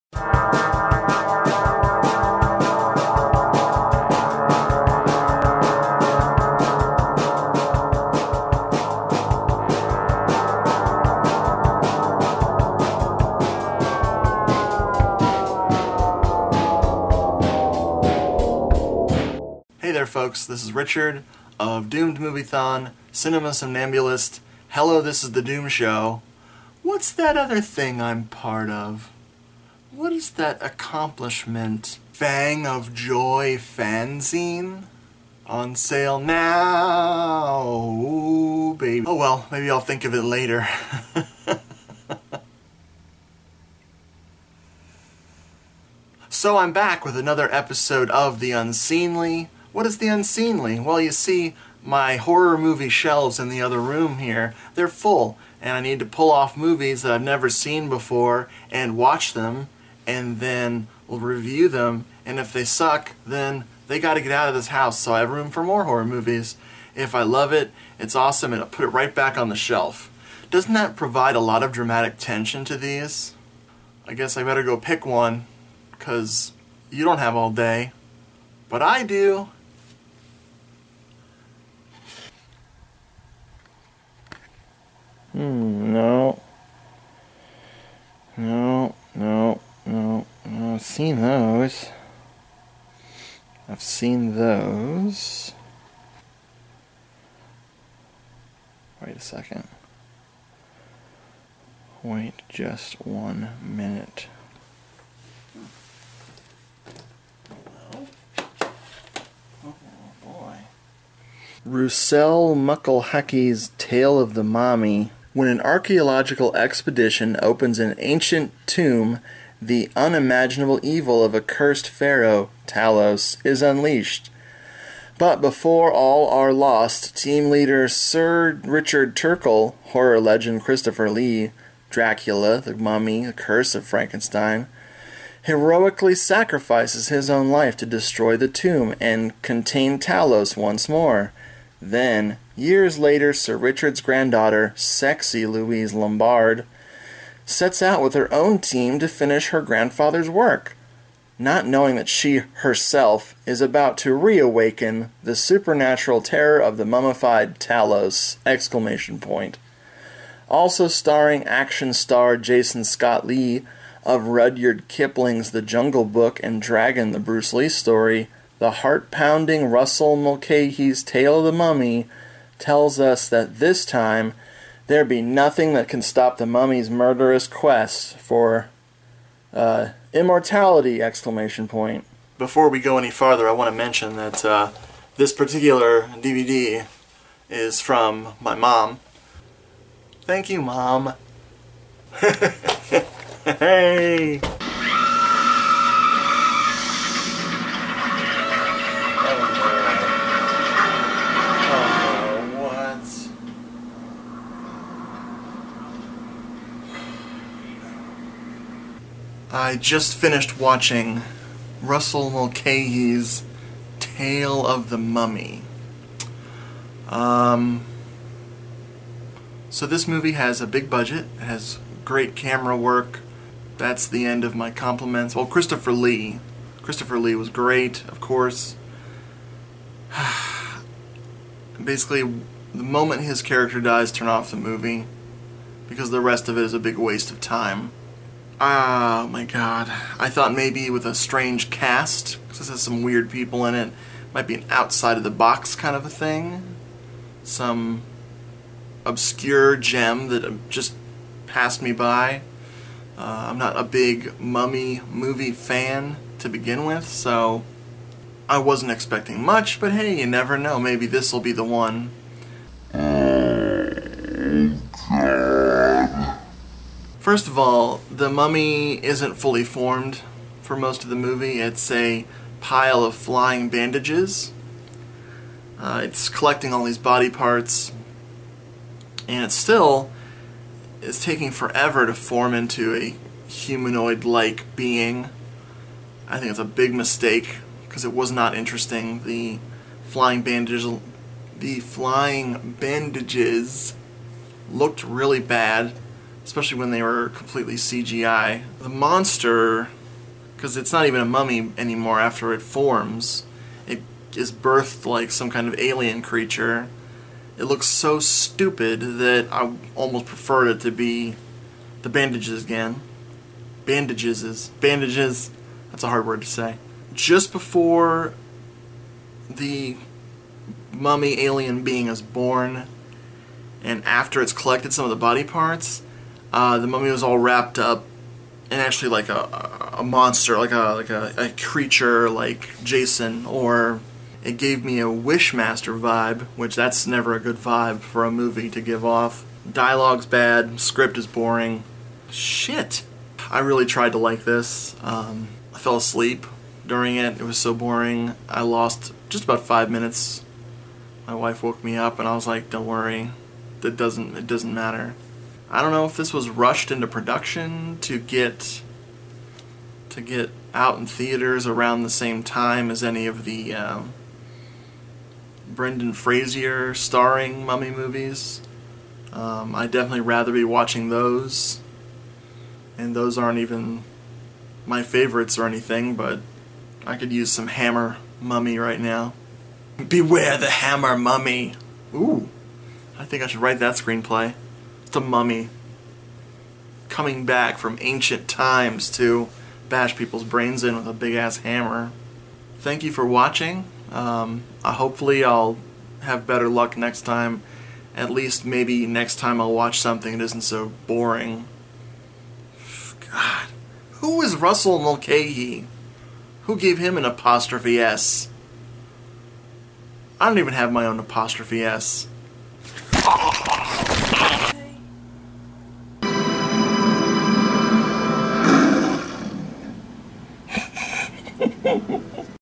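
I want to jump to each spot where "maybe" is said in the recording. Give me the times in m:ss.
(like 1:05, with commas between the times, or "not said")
0:39, 4:00, 4:20, 6:38.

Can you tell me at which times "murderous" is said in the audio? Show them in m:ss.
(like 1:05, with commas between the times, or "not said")
2:56.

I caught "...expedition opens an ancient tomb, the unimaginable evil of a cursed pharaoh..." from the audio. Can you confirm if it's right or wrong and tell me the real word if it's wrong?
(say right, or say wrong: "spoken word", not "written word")
right.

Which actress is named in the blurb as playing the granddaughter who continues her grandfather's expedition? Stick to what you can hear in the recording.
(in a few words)
Louise Lombard.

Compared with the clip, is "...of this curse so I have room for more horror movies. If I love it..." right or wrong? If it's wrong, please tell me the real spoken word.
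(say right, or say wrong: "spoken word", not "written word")
wrong: "house", not "curse".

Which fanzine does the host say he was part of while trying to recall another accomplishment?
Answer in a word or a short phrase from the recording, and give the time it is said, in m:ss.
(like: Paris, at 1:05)
Fang of Joy, at 0:32.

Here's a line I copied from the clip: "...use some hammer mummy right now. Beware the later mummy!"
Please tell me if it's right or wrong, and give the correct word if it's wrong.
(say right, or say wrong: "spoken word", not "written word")
wrong: "hammer", not "later".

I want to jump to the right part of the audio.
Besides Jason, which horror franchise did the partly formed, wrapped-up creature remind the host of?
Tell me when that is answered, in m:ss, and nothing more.
5:35.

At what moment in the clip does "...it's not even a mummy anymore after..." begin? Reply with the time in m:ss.
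5:00.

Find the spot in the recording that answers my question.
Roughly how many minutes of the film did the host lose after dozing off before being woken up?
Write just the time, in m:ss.
5:49.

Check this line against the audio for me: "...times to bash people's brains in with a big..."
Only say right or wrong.
right.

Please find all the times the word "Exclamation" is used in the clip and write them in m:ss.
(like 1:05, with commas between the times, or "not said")
2:38, 3:01.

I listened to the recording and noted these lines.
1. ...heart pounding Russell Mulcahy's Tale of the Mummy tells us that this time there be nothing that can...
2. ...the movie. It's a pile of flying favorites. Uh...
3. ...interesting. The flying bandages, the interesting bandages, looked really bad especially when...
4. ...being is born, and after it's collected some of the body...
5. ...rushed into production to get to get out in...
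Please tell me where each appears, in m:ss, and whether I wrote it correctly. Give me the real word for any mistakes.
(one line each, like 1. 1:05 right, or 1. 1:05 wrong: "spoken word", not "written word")
1. 2:48 right
2. 4:31 wrong: "bandages", not "favorites"
3. 4:48 wrong: "flying", not "interesting"
4. 5:21 right
5. 5:56 right.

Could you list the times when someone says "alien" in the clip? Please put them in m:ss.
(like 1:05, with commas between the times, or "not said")
5:05, 5:21.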